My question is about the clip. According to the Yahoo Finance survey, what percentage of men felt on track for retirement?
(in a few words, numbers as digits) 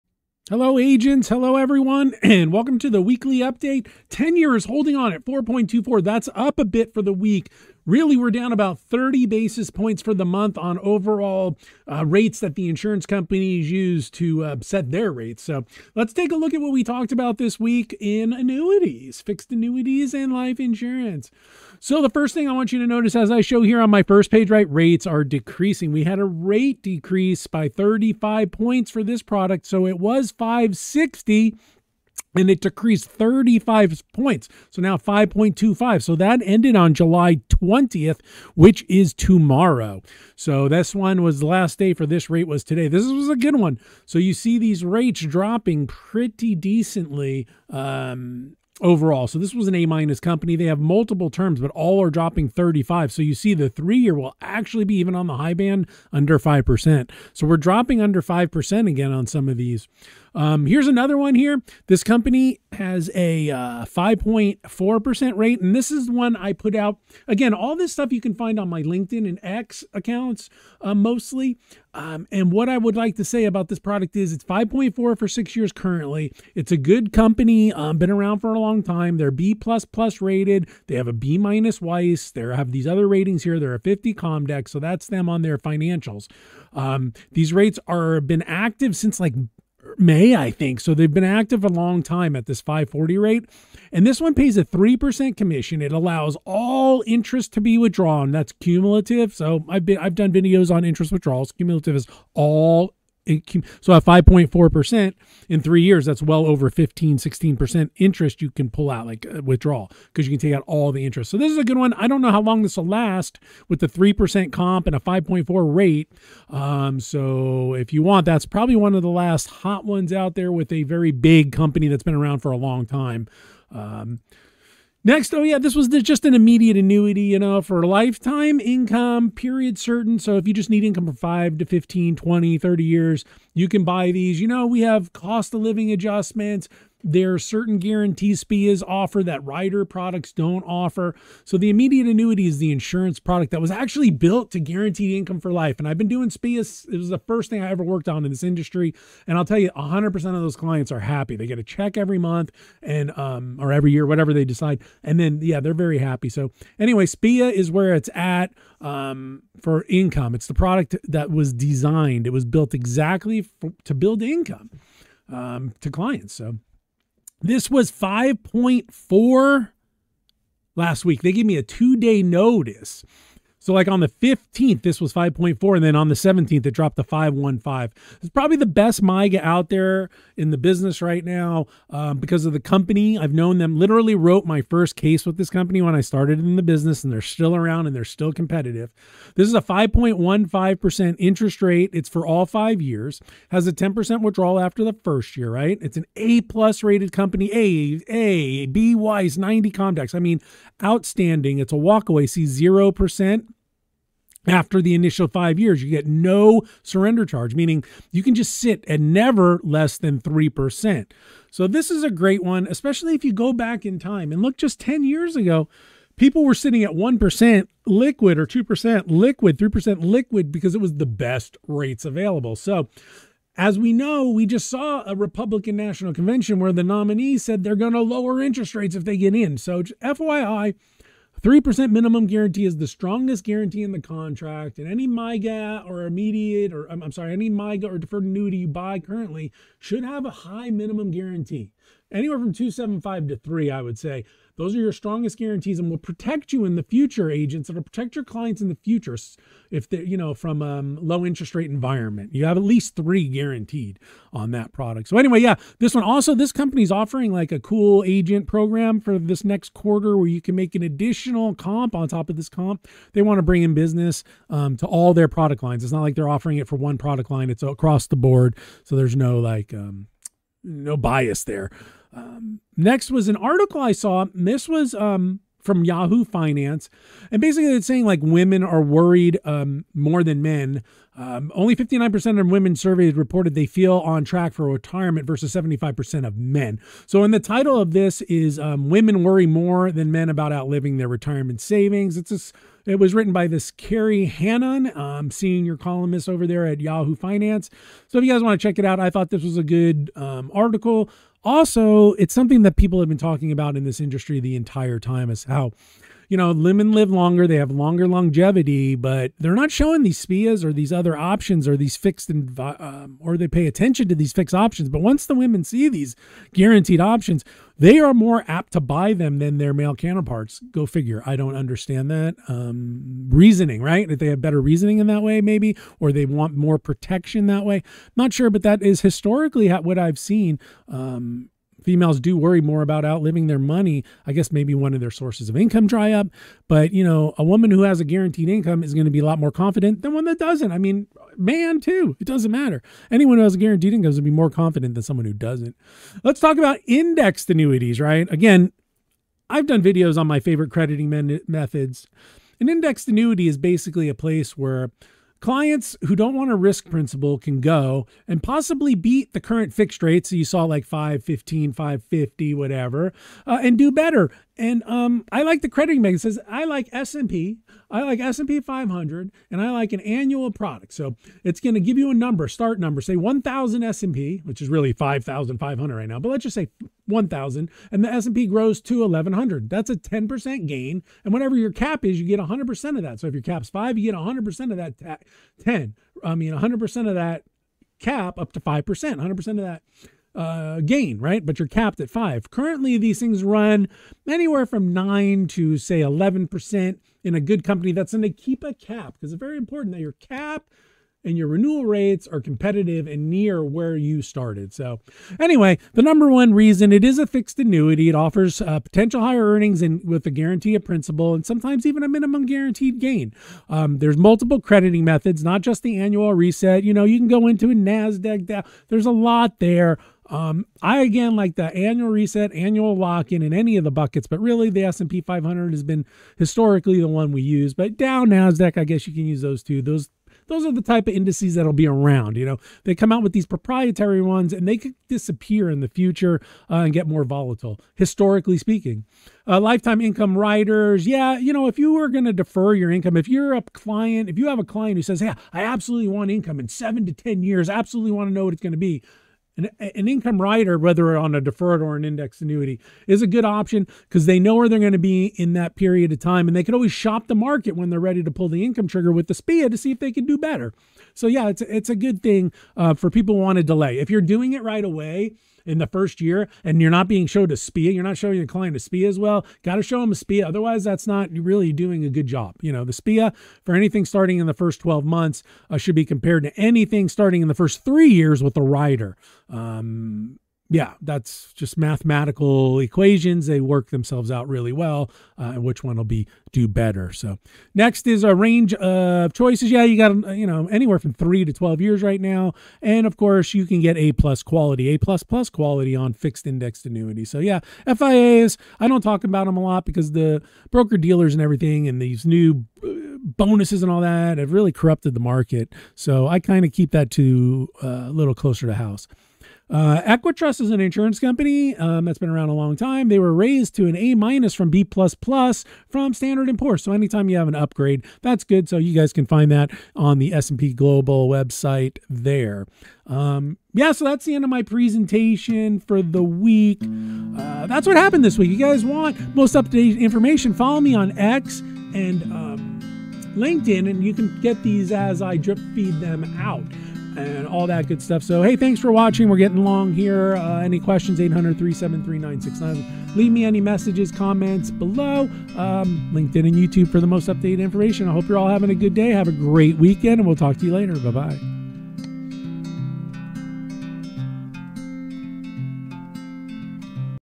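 75%.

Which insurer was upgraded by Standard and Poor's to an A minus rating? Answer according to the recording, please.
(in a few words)
Equitrust.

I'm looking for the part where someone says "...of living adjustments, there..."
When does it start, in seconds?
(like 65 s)
135 s.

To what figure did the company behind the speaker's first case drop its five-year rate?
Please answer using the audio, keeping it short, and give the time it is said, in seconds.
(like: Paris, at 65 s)
5.15%, at 189 s.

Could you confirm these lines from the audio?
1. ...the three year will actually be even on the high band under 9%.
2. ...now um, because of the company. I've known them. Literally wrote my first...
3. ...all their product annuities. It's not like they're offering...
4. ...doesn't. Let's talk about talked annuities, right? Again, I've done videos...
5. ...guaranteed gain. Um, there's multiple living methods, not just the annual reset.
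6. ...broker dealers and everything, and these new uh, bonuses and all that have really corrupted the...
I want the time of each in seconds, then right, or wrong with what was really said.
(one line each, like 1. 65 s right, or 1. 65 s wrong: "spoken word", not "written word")
1. 53 s wrong: "5", not "9"
2. 181 s right
3. 264 s wrong: "lines", not "annuities"
4. 345 s wrong: "indexed", not "talked"
5. 412 s wrong: "crediting", not "living"
6. 500 s right.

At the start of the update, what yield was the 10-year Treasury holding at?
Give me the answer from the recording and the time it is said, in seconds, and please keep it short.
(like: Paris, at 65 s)
4.24, at 5 s.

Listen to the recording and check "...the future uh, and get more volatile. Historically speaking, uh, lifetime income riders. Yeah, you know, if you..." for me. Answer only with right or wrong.
right.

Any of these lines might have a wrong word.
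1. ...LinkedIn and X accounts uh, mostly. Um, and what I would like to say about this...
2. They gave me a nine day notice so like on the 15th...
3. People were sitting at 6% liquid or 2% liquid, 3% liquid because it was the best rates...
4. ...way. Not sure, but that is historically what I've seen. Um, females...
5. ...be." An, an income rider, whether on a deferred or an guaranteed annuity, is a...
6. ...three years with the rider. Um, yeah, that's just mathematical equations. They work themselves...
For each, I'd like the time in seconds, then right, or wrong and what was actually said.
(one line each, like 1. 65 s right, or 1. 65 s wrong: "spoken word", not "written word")
1. 68 s right
2. 171 s wrong: "two", not "nine"
3. 216 s wrong: "1", not "6"
4. 327 s right
5. 448 s wrong: "indexed", not "guaranteed"
6. 477 s right.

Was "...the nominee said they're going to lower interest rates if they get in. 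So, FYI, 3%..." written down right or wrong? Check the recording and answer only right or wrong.
right.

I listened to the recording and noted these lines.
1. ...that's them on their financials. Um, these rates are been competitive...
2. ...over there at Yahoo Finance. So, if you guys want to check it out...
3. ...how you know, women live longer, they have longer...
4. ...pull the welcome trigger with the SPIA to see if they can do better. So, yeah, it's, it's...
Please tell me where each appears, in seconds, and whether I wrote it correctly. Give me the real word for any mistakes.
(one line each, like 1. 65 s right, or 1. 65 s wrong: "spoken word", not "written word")
1. 84 s wrong: "active", not "competitive"
2. 296 s right
3. 305 s right
4. 458 s wrong: "income", not "welcome".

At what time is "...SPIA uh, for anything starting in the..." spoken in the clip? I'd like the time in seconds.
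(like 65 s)
472 s.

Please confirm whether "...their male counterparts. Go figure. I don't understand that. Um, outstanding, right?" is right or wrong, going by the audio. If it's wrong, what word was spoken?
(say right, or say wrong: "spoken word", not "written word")
wrong: "reasoning", not "outstanding".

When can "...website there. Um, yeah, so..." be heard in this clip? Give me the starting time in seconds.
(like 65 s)
521 s.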